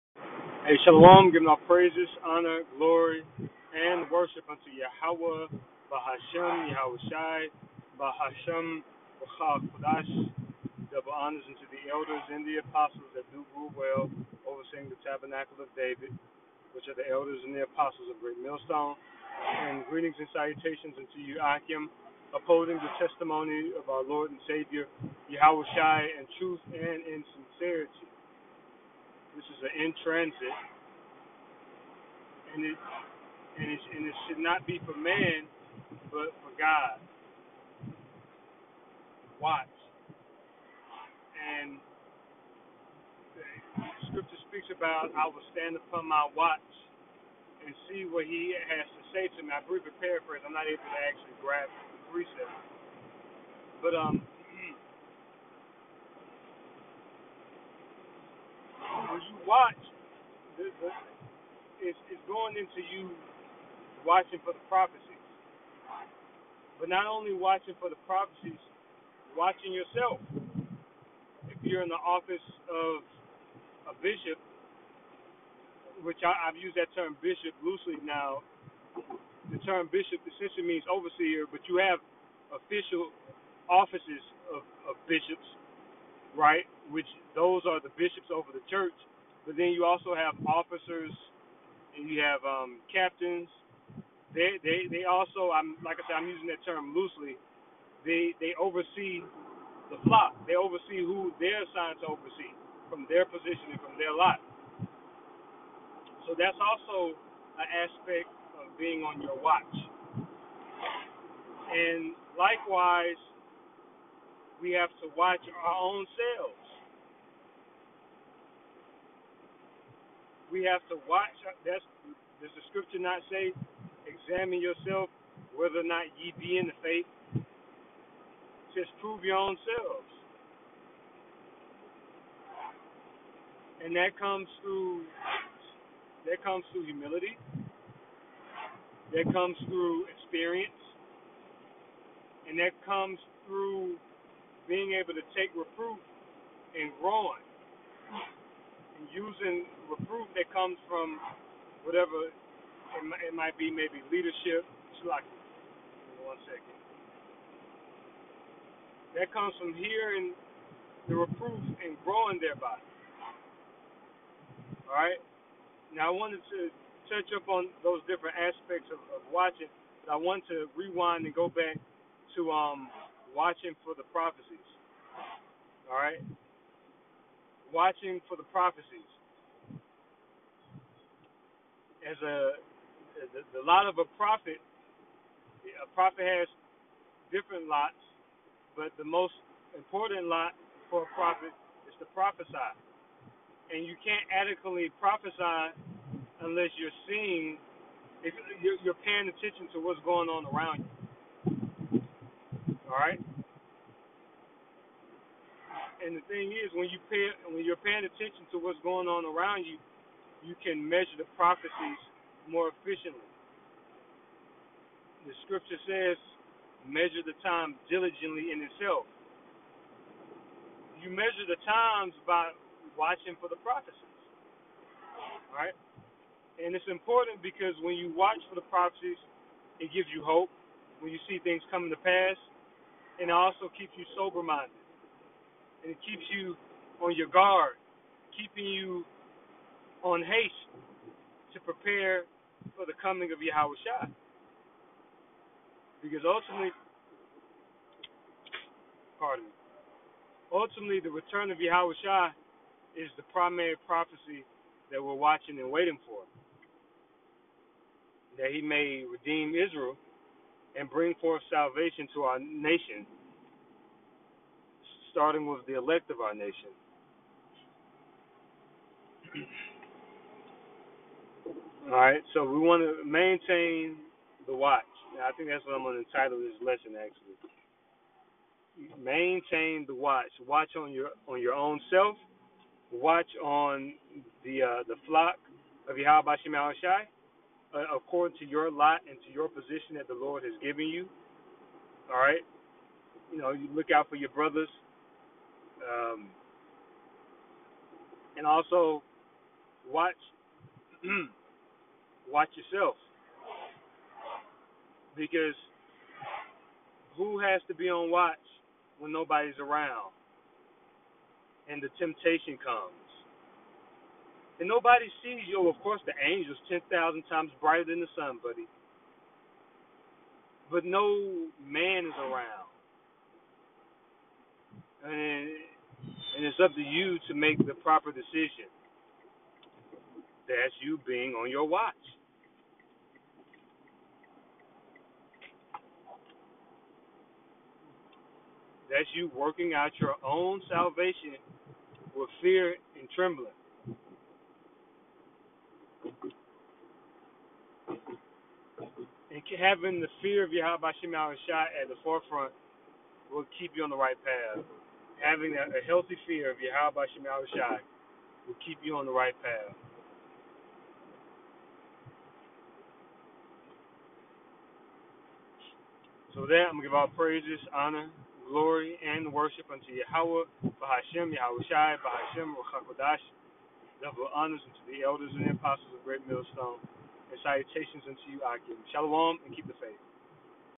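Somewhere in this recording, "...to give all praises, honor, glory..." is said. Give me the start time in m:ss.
6:06.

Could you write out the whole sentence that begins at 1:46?
So that's also an aspect of being on your watch.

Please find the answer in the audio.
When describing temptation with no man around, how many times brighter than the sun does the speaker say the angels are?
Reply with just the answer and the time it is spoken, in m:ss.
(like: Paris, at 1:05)
10,000, at 5:16.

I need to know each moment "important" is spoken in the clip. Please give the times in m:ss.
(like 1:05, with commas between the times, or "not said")
3:09, 3:46.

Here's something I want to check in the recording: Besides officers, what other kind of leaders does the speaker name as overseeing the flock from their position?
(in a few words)
captains.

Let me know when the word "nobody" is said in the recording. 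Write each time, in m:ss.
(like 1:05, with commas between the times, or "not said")
5:09, 5:14.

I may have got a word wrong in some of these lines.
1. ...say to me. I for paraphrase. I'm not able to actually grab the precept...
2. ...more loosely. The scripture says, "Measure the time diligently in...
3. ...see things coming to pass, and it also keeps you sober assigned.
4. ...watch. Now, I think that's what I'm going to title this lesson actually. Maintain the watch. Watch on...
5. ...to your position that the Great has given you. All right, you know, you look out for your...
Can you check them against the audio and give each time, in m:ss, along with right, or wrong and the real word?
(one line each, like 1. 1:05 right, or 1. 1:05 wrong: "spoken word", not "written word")
1. 0:49 right
2. 3:32 wrong: "efficiently", not "loosely"
3. 3:51 wrong: "minded", not "assigned"
4. 4:34 right
5. 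4:49 wrong: "Lord", not "Great".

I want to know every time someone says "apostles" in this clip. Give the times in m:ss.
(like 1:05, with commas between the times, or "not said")
0:12, 0:17, 6:15.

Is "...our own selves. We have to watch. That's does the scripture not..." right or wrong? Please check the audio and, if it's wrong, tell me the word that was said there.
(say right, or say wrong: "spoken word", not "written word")
right.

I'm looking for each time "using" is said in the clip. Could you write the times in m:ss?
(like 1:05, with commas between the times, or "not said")
1:36, 2:29.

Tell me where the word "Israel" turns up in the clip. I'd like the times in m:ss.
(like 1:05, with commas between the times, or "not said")
4:19.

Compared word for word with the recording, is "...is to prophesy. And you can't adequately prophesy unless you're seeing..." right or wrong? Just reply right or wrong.
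right.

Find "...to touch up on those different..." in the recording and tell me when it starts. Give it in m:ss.
2:46.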